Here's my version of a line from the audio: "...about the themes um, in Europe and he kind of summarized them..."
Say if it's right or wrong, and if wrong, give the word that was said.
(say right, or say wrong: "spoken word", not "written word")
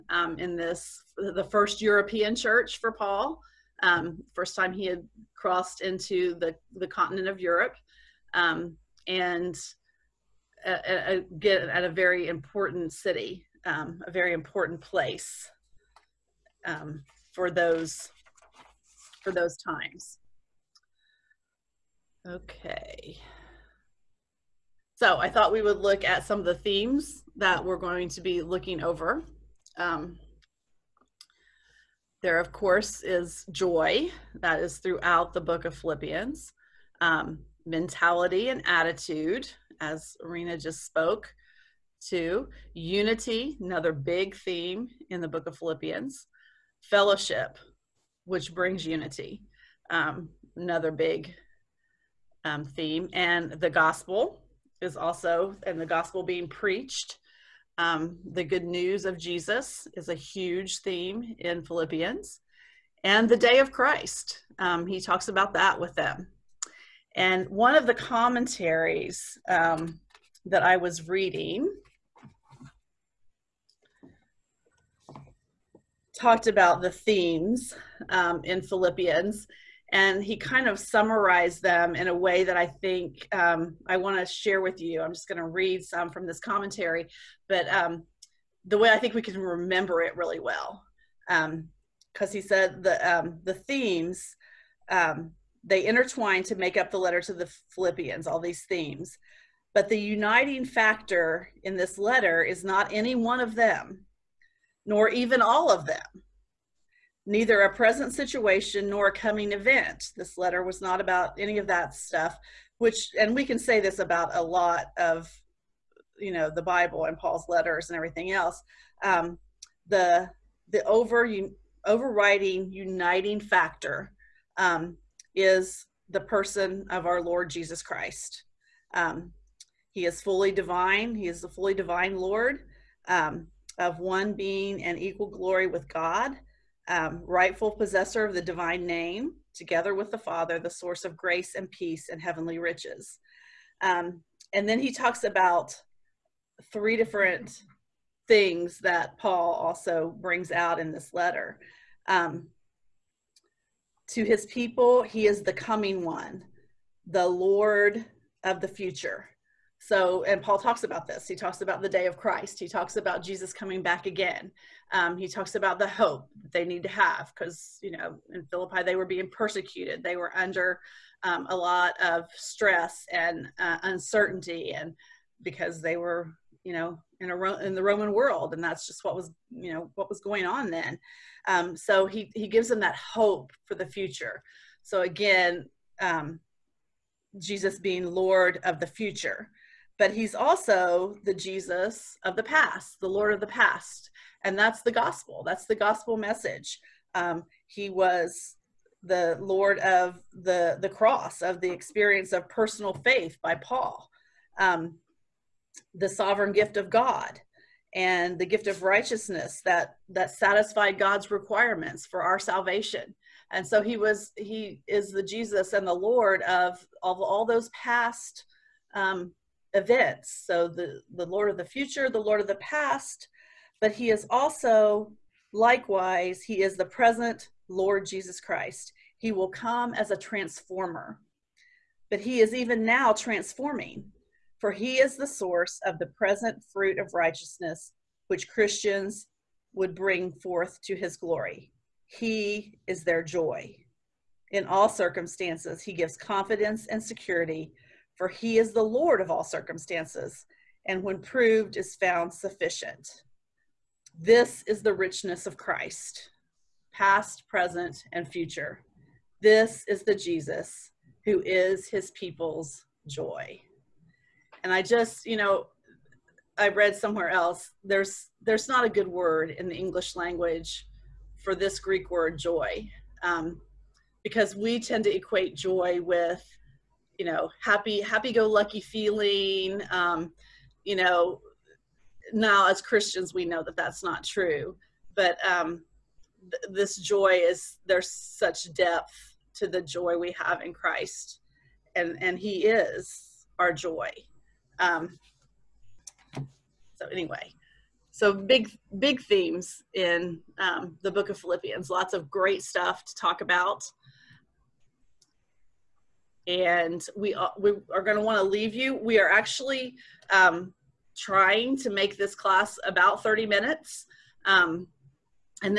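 wrong: "Philippians", not "Europe".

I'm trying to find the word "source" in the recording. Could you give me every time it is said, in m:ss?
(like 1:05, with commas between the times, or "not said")
2:20, 3:55.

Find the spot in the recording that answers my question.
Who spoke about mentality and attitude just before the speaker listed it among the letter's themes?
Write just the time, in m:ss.
0:40.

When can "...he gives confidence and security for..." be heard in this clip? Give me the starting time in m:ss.
4:05.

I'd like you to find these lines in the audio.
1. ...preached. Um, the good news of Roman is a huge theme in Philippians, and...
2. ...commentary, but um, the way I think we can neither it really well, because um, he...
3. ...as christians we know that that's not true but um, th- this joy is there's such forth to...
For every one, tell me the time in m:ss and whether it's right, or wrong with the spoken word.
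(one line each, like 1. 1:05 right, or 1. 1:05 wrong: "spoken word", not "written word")
1. 0:56 wrong: "Jesus", not "Roman"
2. 1:26 wrong: "remember", not "neither"
3. 4:42 wrong: "depth", not "forth".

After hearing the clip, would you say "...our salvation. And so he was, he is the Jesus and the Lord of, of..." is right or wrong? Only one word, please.
right.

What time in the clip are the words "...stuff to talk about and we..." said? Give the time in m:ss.
5:02.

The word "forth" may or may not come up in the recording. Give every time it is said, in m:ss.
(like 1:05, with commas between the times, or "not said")
4:00.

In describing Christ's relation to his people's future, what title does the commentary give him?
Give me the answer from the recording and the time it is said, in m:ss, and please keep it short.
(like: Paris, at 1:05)
The coming one, at 2:35.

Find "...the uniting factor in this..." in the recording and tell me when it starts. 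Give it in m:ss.
1:39.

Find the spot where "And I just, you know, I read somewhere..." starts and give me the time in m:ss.
4:24.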